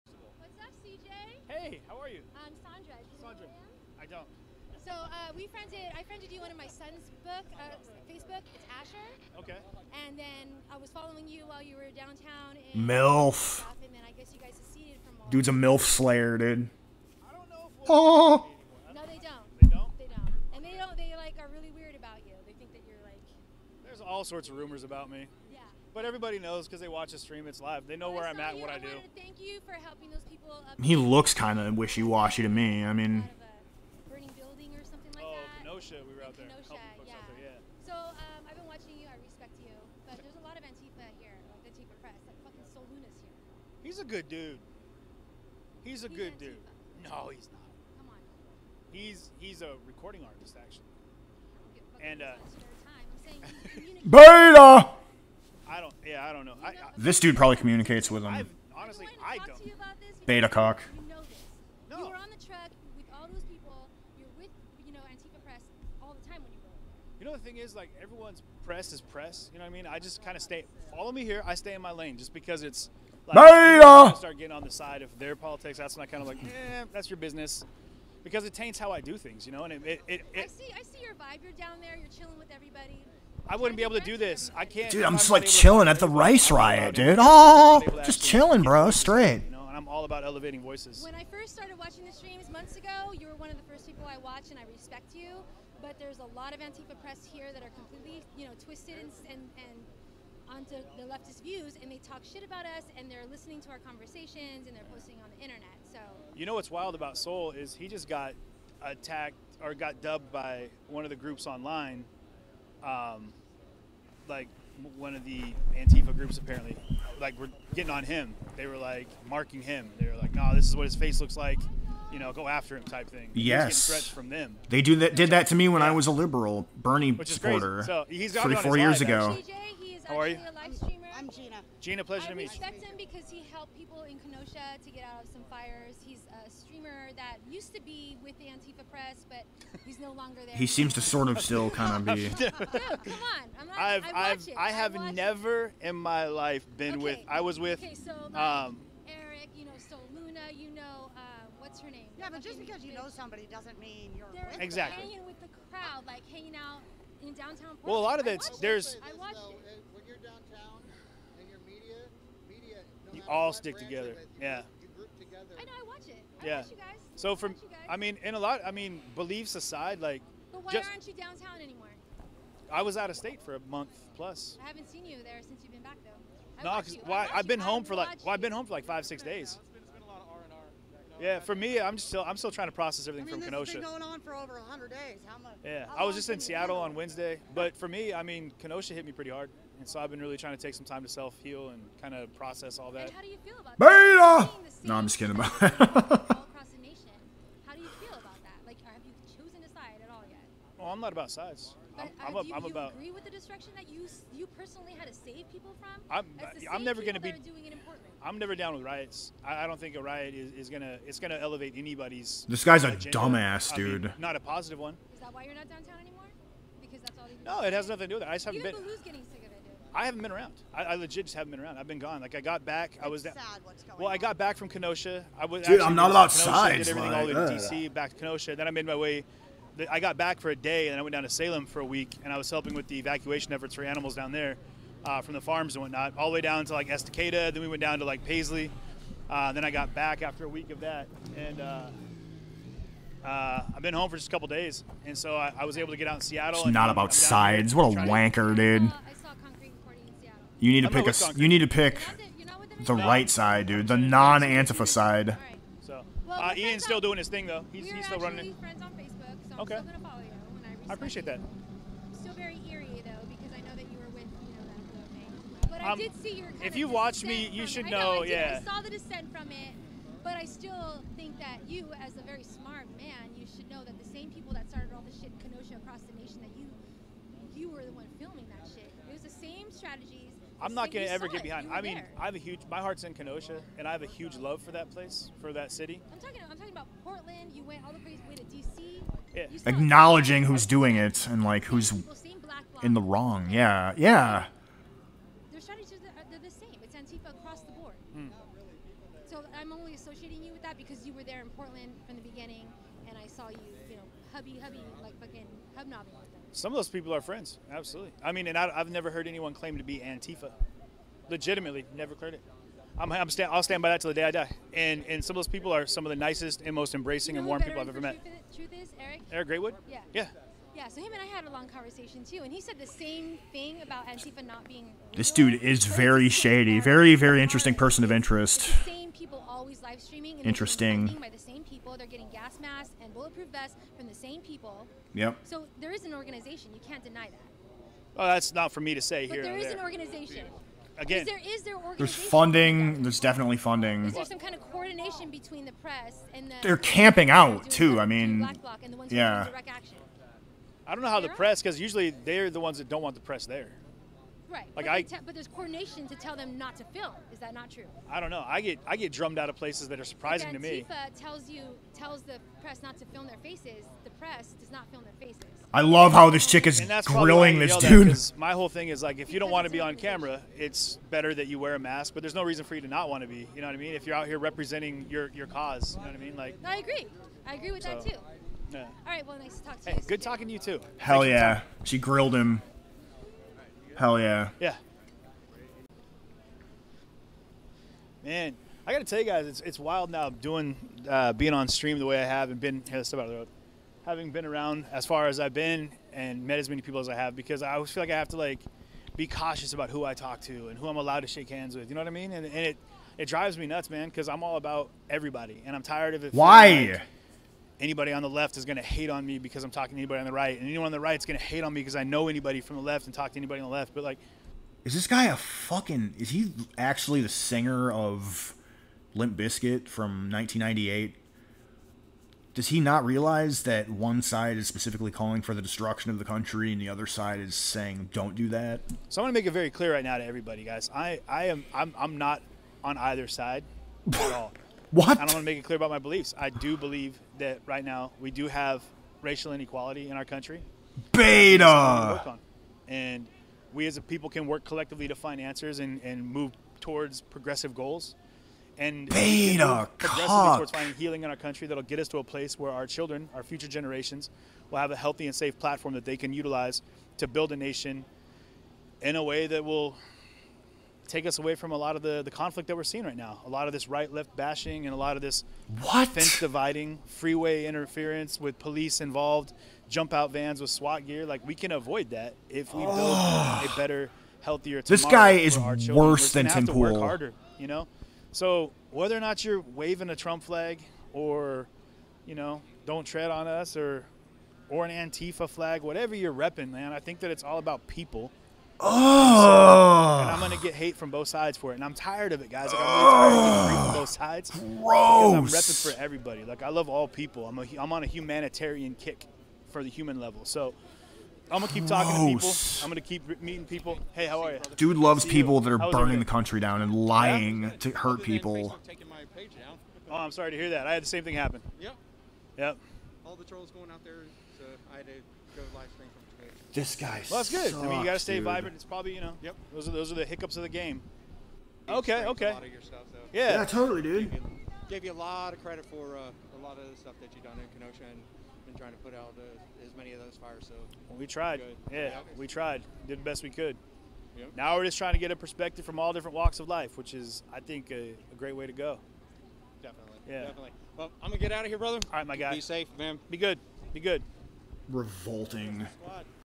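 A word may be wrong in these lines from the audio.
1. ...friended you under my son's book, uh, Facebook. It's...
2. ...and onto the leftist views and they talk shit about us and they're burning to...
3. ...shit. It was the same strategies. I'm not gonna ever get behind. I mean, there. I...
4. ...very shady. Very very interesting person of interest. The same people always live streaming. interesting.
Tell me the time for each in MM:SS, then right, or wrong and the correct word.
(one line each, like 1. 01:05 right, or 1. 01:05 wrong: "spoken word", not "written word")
1. 00:06 right
2. 01:39 wrong: "listening", not "burning"
3. 04:38 right
4. 05:25 right.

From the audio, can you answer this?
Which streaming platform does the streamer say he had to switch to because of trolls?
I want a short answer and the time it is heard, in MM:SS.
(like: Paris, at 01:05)
Twitch, at 08:36.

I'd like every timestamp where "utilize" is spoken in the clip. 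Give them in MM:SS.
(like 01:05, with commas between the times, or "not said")
07:36.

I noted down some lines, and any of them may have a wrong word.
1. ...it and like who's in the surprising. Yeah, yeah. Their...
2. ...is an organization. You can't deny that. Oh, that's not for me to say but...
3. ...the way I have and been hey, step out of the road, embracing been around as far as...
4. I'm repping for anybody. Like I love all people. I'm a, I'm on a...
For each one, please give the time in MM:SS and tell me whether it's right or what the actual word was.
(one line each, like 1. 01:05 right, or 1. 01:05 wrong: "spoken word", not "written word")
1. 04:50 wrong: "wrong", not "surprising"
2. 05:35 right
3. 06:31 wrong: "having", not "embracing"
4. 08:15 wrong: "everybody", not "anybody".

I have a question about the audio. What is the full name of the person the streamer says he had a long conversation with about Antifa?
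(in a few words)
Eric Greatwood.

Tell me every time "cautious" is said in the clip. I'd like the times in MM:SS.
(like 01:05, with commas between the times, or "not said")
06:39.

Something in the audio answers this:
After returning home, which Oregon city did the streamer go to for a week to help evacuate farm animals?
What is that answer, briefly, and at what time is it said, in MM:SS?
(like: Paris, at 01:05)
Salem, at 03:51.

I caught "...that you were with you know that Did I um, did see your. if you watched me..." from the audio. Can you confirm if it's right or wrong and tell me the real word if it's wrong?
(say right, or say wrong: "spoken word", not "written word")
wrong: "But", not "Did".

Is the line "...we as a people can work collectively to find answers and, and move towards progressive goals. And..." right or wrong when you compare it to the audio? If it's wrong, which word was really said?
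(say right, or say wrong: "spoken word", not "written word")
right.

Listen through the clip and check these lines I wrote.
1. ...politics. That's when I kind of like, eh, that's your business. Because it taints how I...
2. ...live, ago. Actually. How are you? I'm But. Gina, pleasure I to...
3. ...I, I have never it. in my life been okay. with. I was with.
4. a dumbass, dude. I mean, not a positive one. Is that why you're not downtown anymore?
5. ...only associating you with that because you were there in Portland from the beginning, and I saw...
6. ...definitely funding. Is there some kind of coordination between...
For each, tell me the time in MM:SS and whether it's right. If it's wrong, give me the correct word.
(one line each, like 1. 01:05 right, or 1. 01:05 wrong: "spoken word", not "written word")
1. 01:15 right
2. 02:08 wrong: "Gina", not "But"
3. 02:24 right
4. 03:33 right
5. 04:59 right
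6. 05:43 right.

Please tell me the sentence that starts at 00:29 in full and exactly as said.
Thank you for helping those people.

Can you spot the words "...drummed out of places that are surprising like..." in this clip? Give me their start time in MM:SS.
05:59.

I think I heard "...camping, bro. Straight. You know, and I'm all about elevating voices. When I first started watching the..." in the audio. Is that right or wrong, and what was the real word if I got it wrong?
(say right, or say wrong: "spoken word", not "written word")
wrong: "chilling", not "camping".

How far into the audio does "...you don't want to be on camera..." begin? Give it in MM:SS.
06:09.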